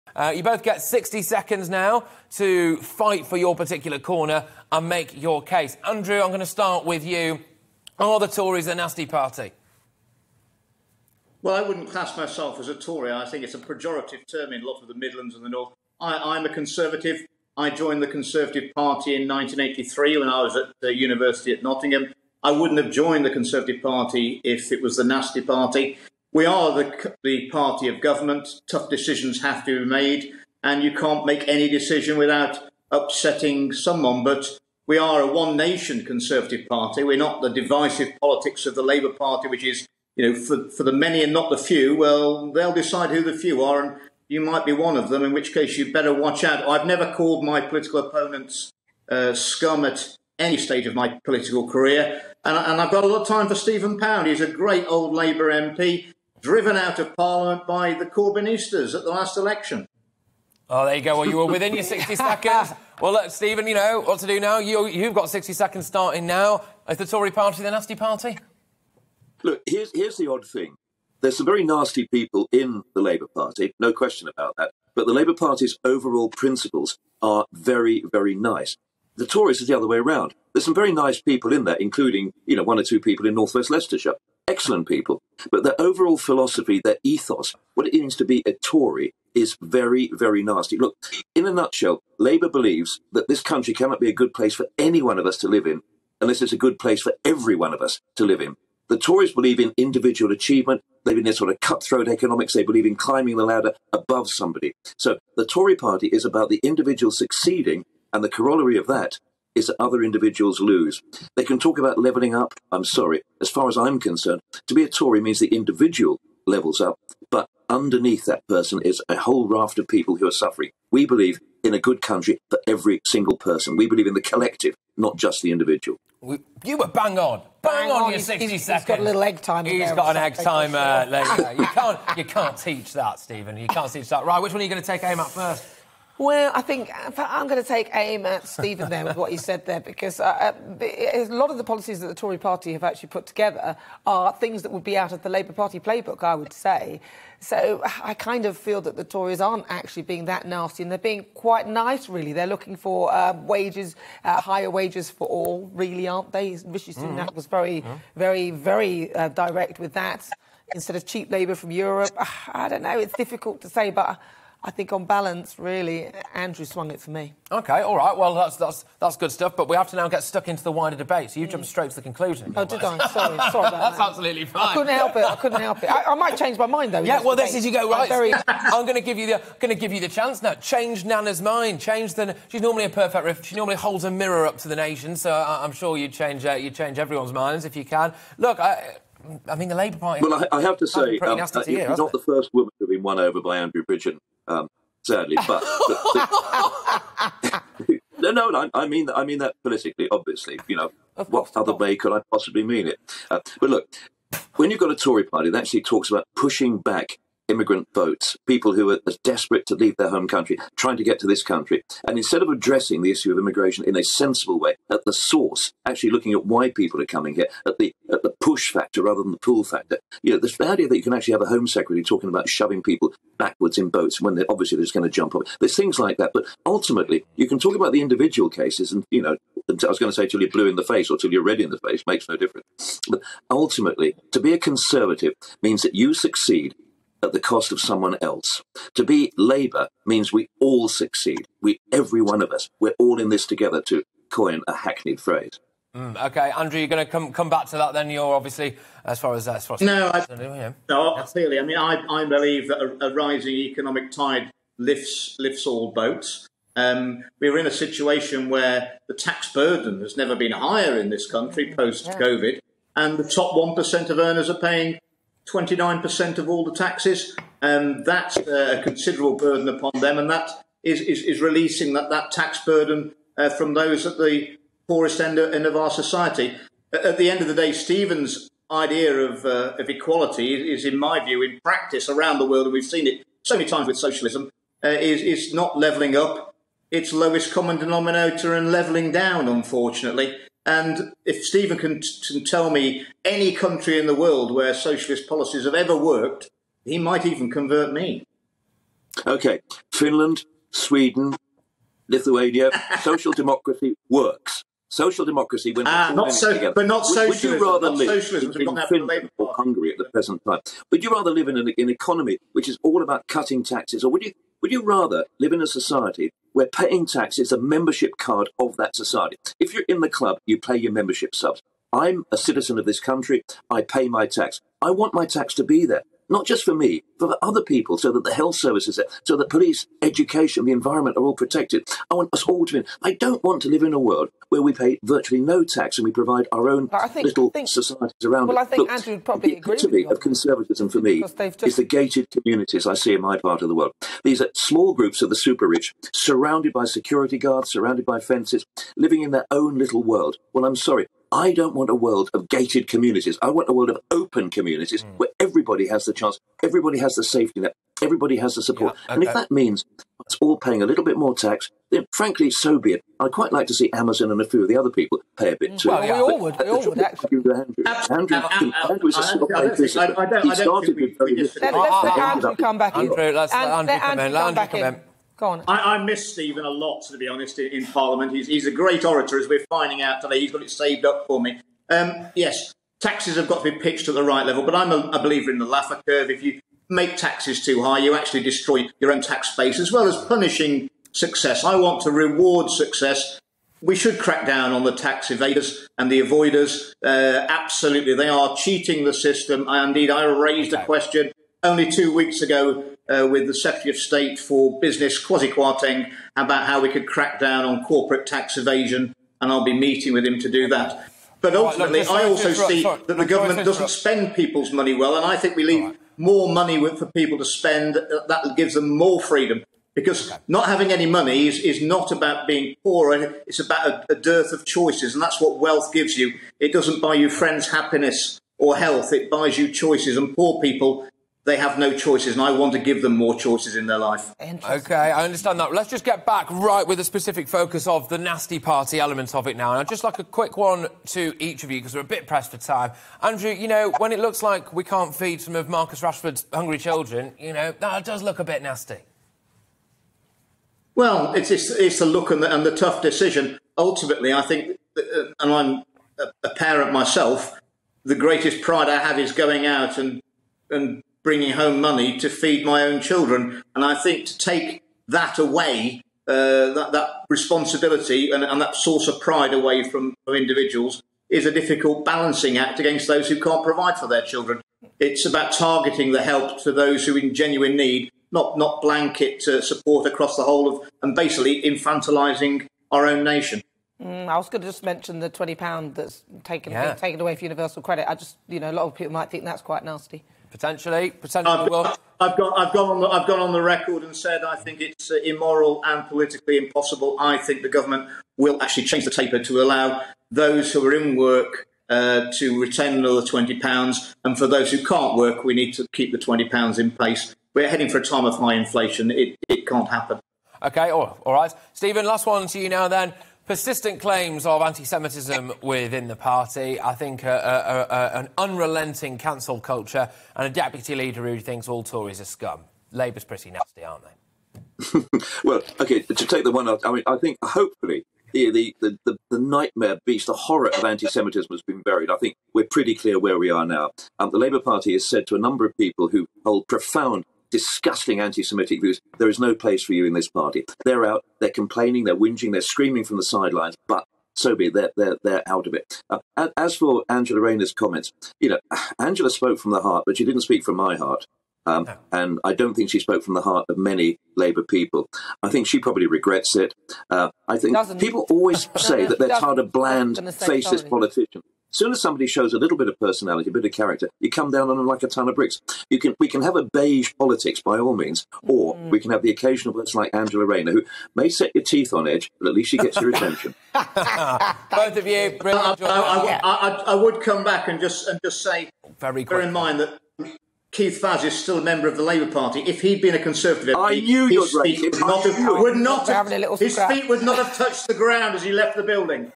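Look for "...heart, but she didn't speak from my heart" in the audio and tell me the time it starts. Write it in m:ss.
9:09.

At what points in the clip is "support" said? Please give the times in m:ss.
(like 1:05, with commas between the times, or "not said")
5:58, 7:59.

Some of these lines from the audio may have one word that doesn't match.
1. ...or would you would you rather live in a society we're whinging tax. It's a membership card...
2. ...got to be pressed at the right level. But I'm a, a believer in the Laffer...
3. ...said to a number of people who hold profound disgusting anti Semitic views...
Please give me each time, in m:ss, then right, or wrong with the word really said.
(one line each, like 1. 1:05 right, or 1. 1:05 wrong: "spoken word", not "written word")
1. 5:14 wrong: "paying", not "whinging"
2. 6:23 wrong: "pitched", not "pressed"
3. 8:55 right.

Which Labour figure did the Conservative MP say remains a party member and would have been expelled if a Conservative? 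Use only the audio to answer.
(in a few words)
Keith Vaz.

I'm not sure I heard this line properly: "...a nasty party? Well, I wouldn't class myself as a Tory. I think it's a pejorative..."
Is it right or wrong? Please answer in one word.
right.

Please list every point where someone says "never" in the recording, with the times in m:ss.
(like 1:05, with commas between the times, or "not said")
0:46, 4:20.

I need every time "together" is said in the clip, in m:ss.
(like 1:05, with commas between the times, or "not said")
2:23, 4:03, 5:06.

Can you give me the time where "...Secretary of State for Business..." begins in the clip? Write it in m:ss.
6:43.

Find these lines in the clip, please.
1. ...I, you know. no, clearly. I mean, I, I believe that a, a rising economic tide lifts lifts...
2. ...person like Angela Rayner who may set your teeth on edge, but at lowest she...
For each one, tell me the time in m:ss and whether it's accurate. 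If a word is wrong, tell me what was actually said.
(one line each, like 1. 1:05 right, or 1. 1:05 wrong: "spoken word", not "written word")
1. 4:10 right
2. 9:29 wrong: "least", not "lowest".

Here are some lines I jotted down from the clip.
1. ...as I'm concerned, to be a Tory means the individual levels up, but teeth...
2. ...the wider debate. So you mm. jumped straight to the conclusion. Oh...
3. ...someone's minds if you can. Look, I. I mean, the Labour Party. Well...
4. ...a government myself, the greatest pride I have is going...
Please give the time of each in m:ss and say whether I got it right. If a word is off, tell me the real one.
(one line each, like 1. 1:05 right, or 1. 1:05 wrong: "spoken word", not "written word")
1. 1:53 wrong: "underneath", not "teeth"
2. 2:50 right
3. 3:06 wrong: "everyone", not "someone"
4. 7:36 wrong: "parent", not "government".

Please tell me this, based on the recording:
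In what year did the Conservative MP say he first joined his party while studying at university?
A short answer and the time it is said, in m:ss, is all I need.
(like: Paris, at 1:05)
1983, at 0:19.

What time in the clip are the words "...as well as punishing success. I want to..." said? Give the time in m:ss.
6:29.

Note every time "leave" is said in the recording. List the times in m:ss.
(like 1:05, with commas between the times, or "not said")
3:29, 6:55.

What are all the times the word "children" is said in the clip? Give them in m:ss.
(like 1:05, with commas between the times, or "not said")
7:26, 7:43, 7:54.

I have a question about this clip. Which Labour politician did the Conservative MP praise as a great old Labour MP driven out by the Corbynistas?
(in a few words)
Stephen Pound.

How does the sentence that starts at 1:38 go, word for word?
The Tories believe in individual achievement.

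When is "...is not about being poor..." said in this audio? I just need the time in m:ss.
7:01.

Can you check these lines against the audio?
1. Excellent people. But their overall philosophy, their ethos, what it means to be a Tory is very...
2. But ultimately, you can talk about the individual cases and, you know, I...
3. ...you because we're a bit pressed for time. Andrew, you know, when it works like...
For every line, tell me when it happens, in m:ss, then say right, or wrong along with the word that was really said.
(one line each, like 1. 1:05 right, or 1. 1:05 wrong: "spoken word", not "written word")
1. 1:24 right
2. 3:46 right
3. 7:21 wrong: "looks", not "works".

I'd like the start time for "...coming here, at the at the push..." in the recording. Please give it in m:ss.
3:37.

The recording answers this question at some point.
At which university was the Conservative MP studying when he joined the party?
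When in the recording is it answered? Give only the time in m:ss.
0:21.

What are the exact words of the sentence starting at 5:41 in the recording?
is the gated communities I see in my part of the world.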